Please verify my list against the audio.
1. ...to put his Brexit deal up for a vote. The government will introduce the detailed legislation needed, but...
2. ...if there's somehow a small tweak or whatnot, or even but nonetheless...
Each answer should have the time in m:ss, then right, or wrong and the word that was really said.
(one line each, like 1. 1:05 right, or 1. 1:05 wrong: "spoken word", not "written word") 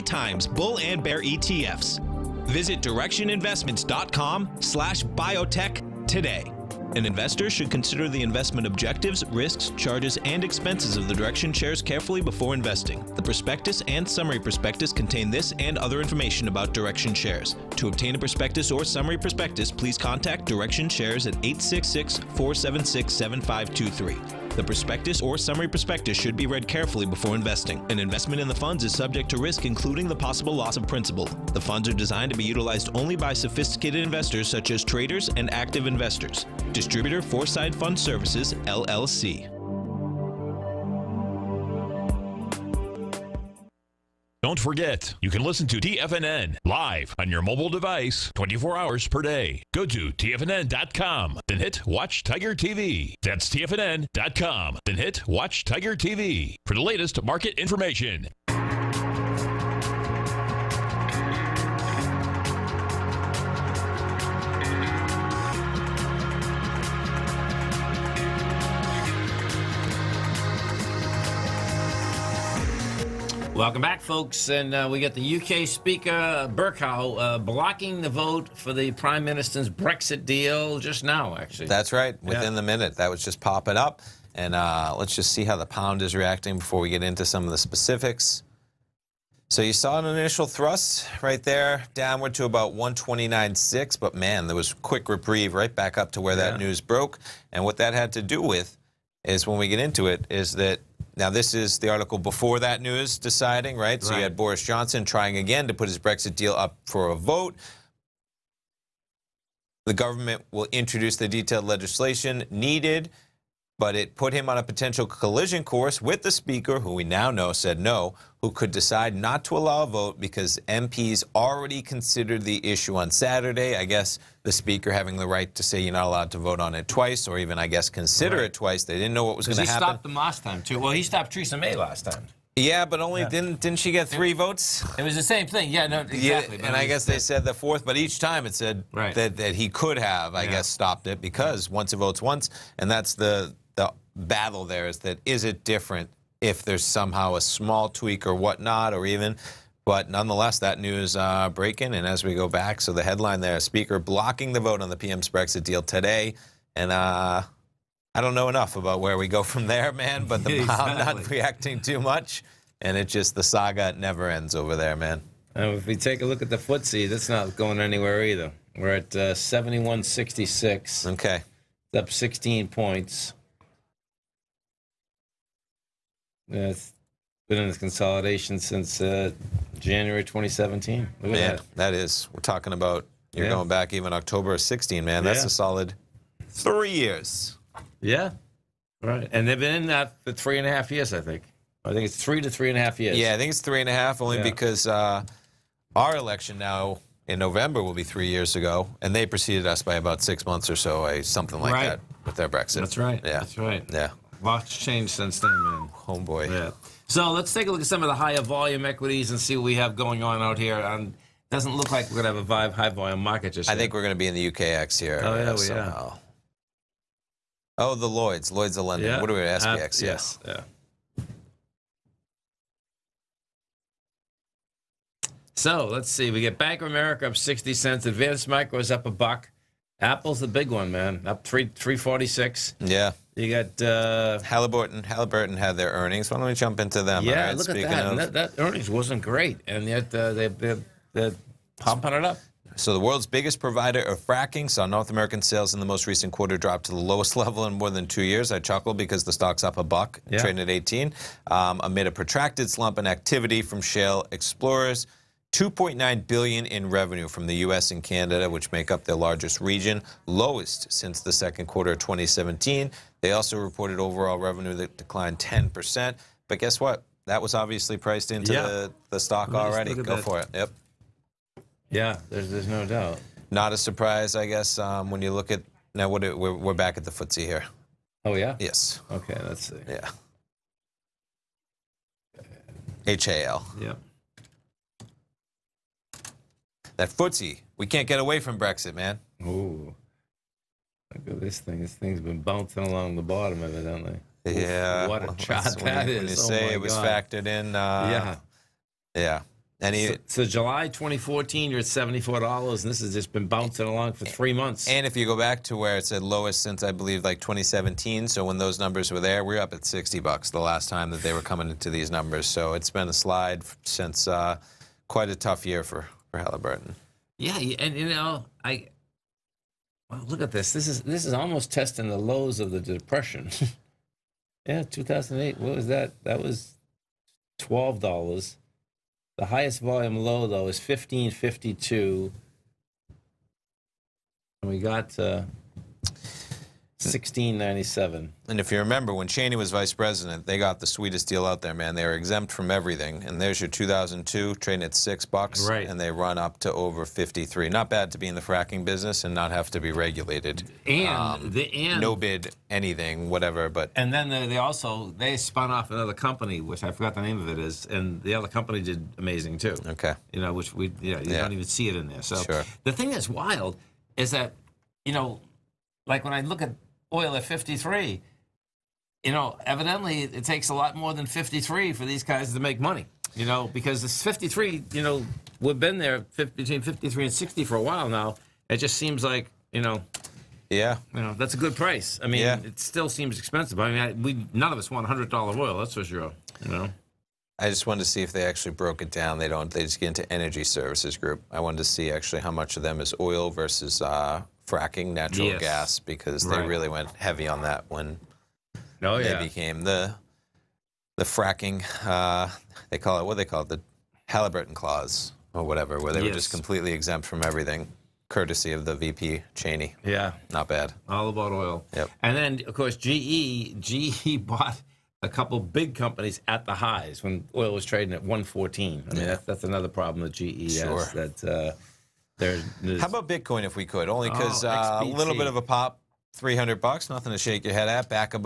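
1. 1:45 right
2. 2:26 right.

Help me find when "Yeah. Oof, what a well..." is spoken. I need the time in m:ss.
4:54.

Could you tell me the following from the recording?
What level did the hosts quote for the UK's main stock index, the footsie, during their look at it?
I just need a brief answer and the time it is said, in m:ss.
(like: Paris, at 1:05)
71.66, at 2:49.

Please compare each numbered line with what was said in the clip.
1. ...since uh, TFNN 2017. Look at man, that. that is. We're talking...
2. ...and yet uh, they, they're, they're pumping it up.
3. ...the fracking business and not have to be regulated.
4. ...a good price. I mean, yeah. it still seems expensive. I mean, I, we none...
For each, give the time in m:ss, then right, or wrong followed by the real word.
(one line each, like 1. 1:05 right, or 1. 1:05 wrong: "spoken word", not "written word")
1. 2:58 wrong: "January", not "TFNN"
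2. 3:59 right
3. 5:48 right
4. 6:21 right.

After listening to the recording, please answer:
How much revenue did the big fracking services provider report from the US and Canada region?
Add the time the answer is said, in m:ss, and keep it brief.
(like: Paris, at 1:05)
2.9 billion, at 4:15.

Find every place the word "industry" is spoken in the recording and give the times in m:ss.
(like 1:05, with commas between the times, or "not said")
not said.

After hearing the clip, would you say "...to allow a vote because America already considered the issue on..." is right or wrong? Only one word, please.
wrong.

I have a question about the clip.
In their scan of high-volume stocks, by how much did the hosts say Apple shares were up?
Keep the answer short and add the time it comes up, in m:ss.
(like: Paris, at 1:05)
3.46, at 3:51.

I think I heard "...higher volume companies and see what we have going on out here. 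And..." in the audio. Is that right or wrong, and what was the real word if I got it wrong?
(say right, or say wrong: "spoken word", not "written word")
wrong: "equities", not "companies".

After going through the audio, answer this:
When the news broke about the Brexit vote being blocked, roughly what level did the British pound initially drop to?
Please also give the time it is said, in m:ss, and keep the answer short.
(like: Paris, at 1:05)
129.6, at 1:32.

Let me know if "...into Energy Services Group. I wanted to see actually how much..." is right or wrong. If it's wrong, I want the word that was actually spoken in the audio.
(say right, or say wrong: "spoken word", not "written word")
right.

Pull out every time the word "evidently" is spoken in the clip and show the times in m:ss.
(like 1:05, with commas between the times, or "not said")
4:53, 6:09.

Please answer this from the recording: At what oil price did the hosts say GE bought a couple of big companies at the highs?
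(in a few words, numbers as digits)
114.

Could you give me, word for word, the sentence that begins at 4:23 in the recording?
They also reported overall revenue that declined 10%, but guess what?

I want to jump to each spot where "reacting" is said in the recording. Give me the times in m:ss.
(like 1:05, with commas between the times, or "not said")
1:26, 2:41.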